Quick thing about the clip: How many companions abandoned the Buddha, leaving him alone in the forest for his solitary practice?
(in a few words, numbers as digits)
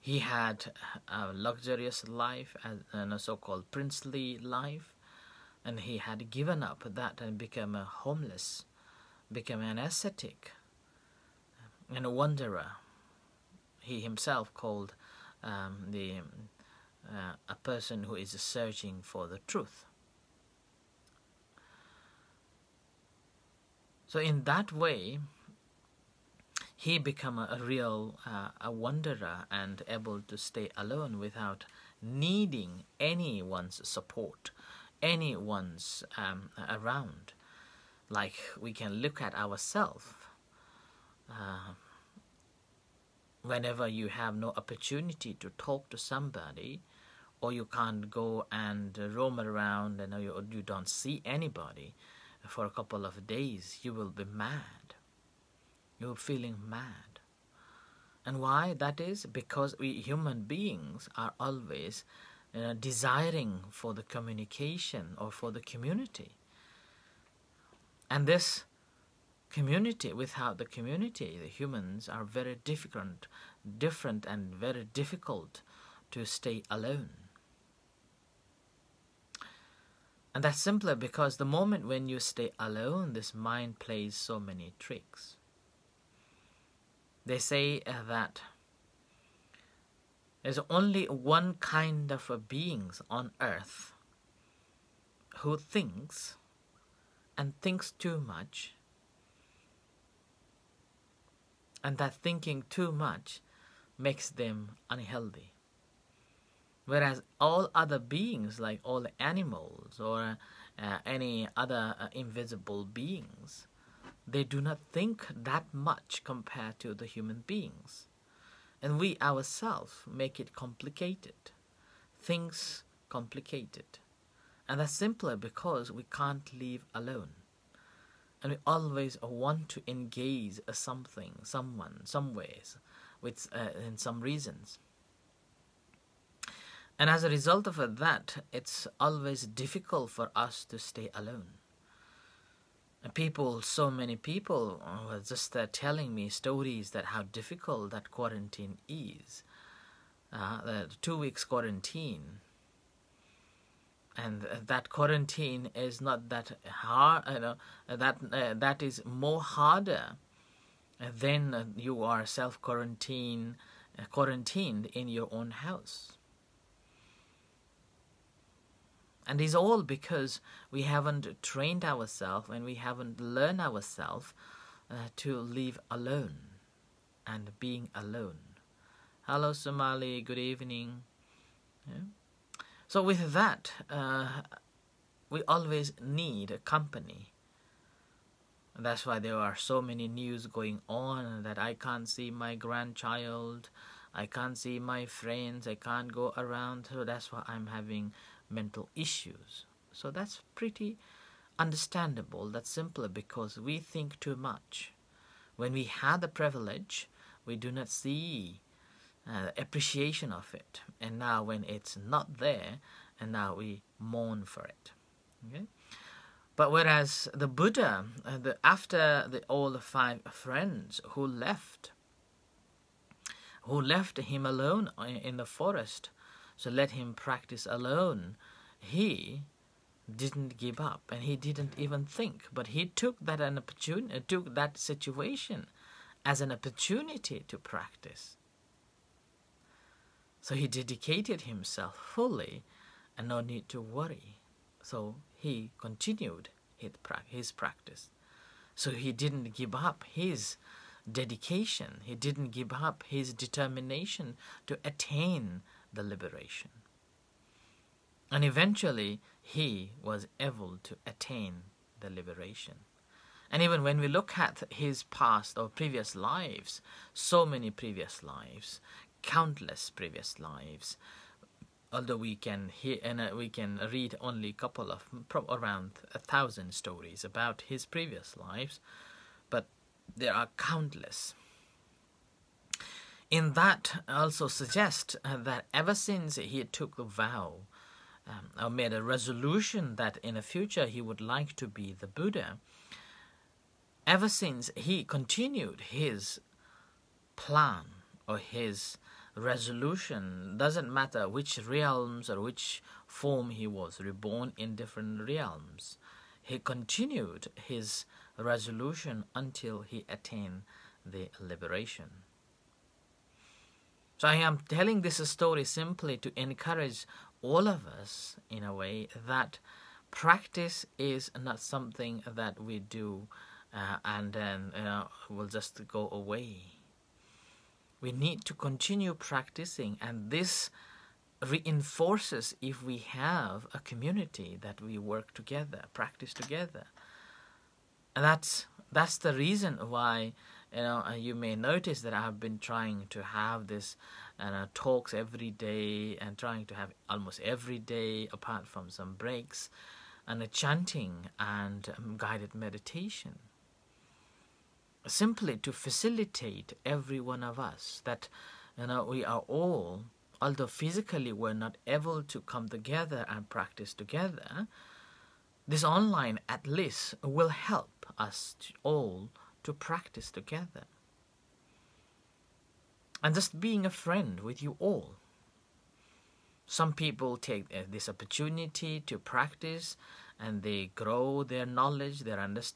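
5.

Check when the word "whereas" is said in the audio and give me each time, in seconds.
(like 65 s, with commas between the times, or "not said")
106 s, 216 s.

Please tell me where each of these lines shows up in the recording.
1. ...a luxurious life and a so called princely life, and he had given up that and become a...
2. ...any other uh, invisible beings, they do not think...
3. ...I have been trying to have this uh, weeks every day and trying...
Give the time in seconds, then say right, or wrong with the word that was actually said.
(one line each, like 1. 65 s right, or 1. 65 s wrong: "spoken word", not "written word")
1. 1 s right
2. 111 s right
3. 342 s wrong: "talks", not "weeks".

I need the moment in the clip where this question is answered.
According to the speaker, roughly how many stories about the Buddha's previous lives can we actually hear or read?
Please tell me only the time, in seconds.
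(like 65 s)
275 s.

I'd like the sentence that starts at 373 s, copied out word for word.
And just being a friend with you all.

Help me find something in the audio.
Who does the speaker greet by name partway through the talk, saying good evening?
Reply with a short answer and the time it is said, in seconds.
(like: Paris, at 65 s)
Somali, at 179 s.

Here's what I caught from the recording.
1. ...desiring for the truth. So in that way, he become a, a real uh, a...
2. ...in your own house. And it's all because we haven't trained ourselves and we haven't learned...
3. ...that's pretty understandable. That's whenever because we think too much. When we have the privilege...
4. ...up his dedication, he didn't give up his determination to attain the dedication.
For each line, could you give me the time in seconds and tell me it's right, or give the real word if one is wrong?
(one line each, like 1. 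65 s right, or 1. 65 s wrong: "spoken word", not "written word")
1. 18 s wrong: "searching", not "desiring"
2. 164 s right
3. 200 s wrong: "simpler", not "whenever"
4. 249 s wrong: "liberation", not "dedication".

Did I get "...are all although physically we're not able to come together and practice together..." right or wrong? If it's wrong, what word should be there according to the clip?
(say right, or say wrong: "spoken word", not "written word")
right.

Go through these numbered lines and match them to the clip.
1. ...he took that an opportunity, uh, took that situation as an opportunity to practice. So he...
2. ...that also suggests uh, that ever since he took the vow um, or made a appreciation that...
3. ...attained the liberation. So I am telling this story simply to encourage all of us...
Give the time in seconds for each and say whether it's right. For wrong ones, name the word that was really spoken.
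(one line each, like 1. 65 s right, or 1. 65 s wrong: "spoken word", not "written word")
1. 232 s right
2. 283 s wrong: "resolution", not "appreciation"
3. 310 s right.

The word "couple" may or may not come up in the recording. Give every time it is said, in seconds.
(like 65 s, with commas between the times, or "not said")
52 s, 274 s.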